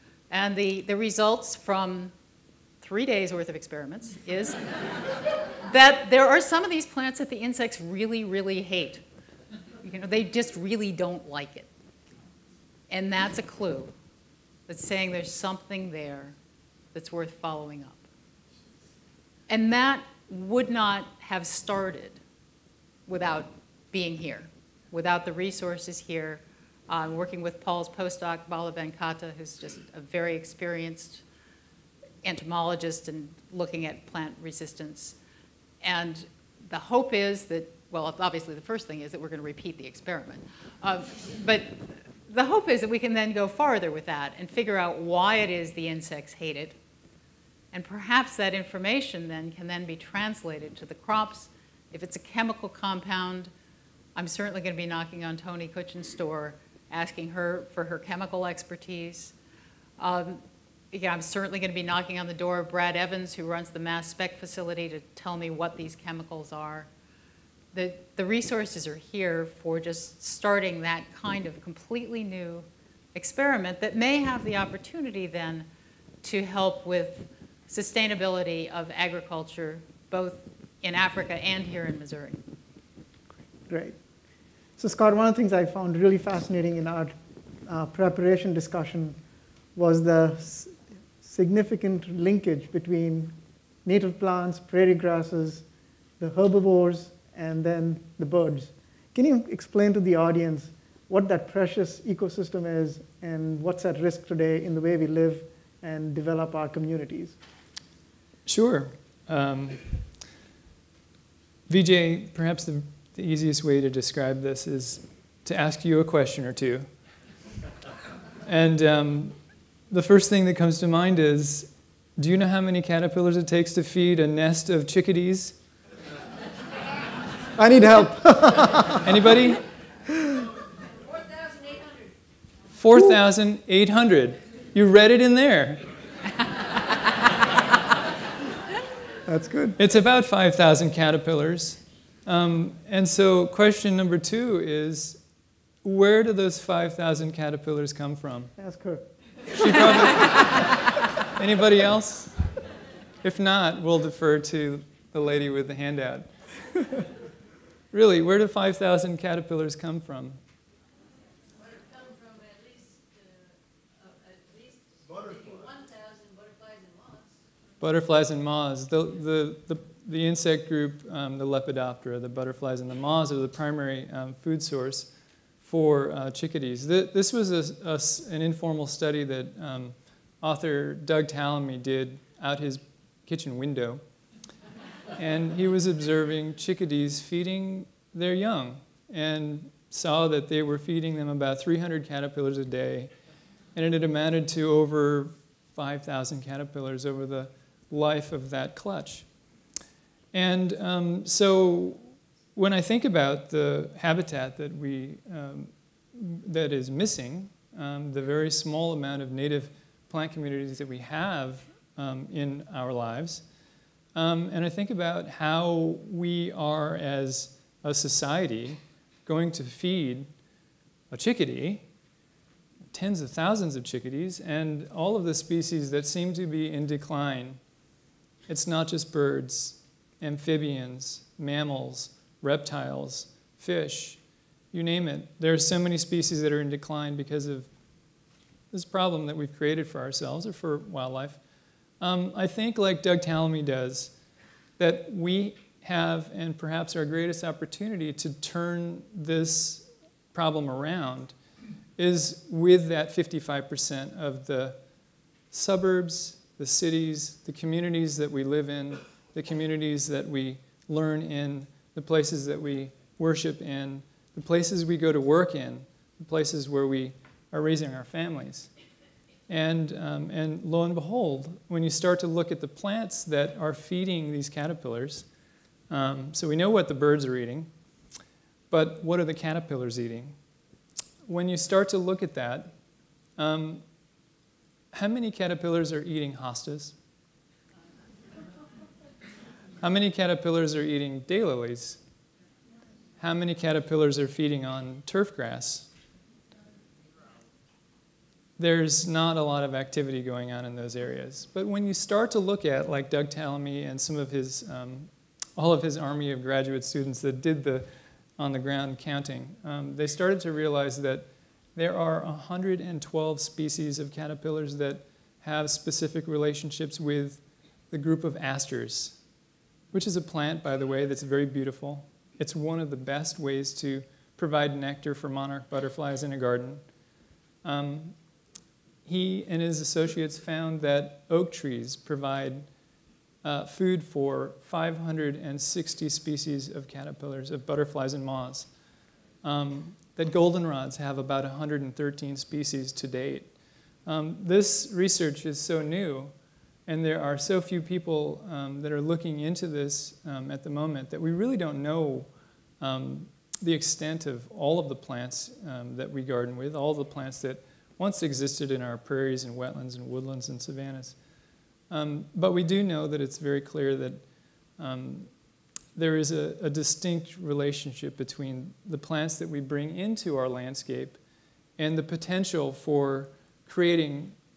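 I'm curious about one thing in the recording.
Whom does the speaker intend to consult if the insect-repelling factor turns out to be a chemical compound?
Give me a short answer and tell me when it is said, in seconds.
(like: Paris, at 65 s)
Toni Kutchan, at 55 s.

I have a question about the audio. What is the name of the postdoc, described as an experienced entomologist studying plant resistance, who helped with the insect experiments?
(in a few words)
Bala Venkata.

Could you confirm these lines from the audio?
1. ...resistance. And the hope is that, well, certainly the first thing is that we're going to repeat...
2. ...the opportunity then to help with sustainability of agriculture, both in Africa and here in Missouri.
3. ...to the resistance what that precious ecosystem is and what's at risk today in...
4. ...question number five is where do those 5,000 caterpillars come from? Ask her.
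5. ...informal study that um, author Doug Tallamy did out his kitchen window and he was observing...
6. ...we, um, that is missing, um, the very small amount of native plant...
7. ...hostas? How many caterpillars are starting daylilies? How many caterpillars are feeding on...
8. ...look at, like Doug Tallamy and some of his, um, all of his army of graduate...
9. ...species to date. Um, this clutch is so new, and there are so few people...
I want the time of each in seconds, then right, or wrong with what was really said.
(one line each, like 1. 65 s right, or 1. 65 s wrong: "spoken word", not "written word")
1. 34 s wrong: "obviously", not "certainly"
2. 74 s right
3. 99 s wrong: "audience", not "resistance"
4. 143 s wrong: "two", not "five"
5. 178 s right
6. 204 s right
7. 286 s wrong: "eating", not "starting"
8. 302 s right
9. 342 s wrong: "research", not "clutch".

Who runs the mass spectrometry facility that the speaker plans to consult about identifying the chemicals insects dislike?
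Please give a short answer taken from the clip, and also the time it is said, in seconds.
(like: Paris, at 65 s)
Brad Evans, at 62 s.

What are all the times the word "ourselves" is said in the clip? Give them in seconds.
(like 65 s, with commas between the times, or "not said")
240 s.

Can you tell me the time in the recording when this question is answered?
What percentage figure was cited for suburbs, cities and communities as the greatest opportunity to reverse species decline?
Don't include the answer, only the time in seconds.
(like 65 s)
253 s.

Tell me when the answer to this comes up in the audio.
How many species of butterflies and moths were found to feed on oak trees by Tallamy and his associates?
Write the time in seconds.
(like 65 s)
334 s.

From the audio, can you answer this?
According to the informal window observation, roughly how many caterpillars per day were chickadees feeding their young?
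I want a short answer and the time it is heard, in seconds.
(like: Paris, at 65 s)
300, at 191 s.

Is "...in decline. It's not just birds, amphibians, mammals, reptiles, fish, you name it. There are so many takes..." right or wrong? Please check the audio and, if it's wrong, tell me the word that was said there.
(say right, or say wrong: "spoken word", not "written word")
wrong: "species", not "takes".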